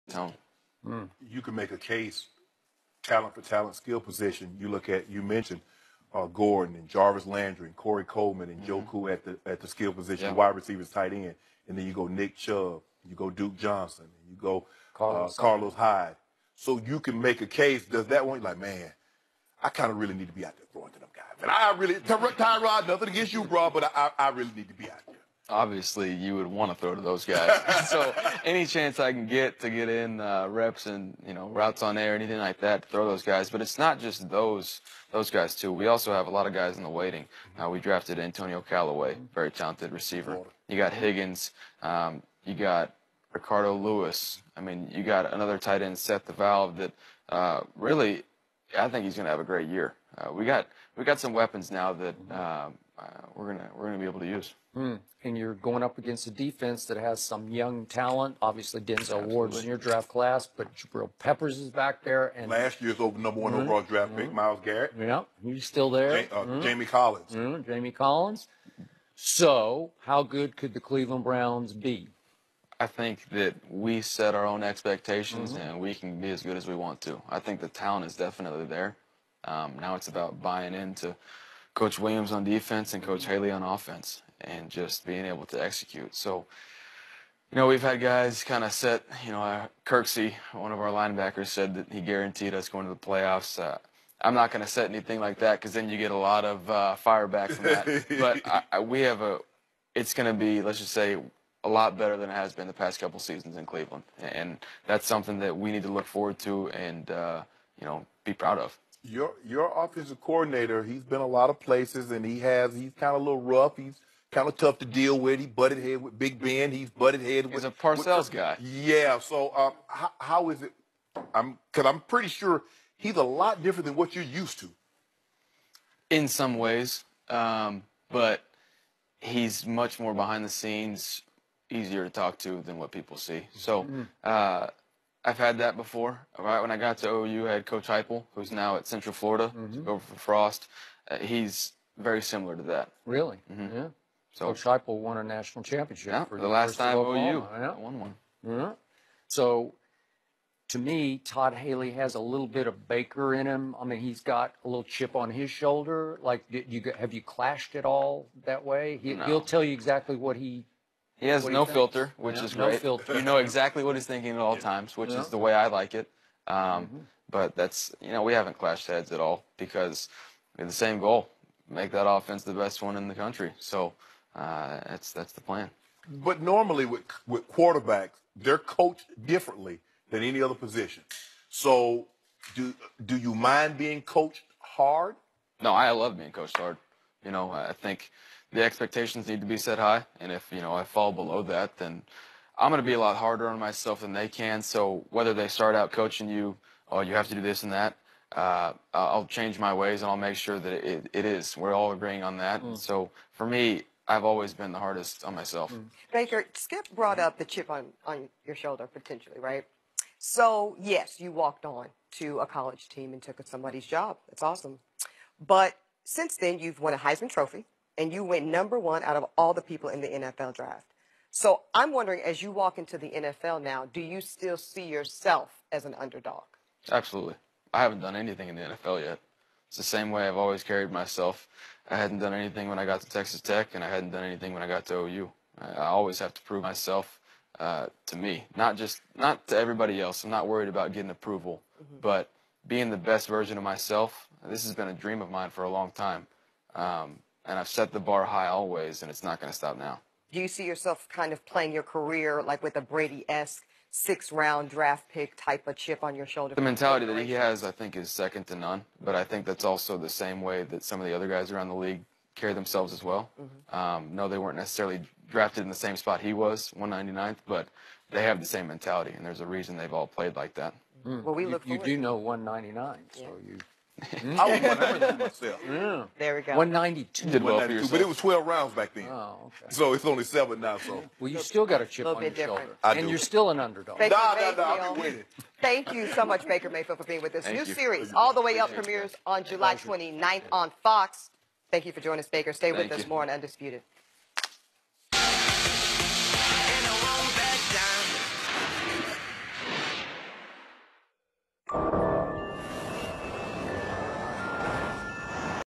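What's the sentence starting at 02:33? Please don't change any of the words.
I mean, he's got a little chip on his shoulder.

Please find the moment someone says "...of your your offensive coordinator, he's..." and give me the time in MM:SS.
01:48.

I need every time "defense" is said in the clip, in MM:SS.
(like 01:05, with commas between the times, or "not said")
00:56, 01:22.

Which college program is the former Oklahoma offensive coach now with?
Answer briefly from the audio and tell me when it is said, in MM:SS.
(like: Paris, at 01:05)
Central Florida, at 02:18.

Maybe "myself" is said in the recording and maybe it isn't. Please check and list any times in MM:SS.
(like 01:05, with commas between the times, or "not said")
03:13, 03:25, 03:50, 03:56, 04:03, 04:35.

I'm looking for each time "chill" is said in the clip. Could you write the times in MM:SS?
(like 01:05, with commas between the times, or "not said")
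not said.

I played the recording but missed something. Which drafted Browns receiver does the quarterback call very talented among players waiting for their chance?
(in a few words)
Antonio Callaway.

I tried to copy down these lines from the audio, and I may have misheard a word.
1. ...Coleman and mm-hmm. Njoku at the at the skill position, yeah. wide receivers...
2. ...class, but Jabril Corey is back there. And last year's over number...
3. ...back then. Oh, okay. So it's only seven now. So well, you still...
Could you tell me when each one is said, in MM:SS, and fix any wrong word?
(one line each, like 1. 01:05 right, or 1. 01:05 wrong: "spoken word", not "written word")
1. 00:08 right
2. 01:00 wrong: "Peppers", not "Corey"
3. 04:38 right.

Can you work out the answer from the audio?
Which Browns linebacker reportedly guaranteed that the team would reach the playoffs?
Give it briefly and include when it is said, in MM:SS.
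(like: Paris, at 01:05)
Kirksey, at 01:29.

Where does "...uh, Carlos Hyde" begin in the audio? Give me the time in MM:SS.
00:15.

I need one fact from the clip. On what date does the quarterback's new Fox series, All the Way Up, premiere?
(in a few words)
July 29.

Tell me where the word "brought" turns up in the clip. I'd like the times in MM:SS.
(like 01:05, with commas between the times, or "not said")
03:26.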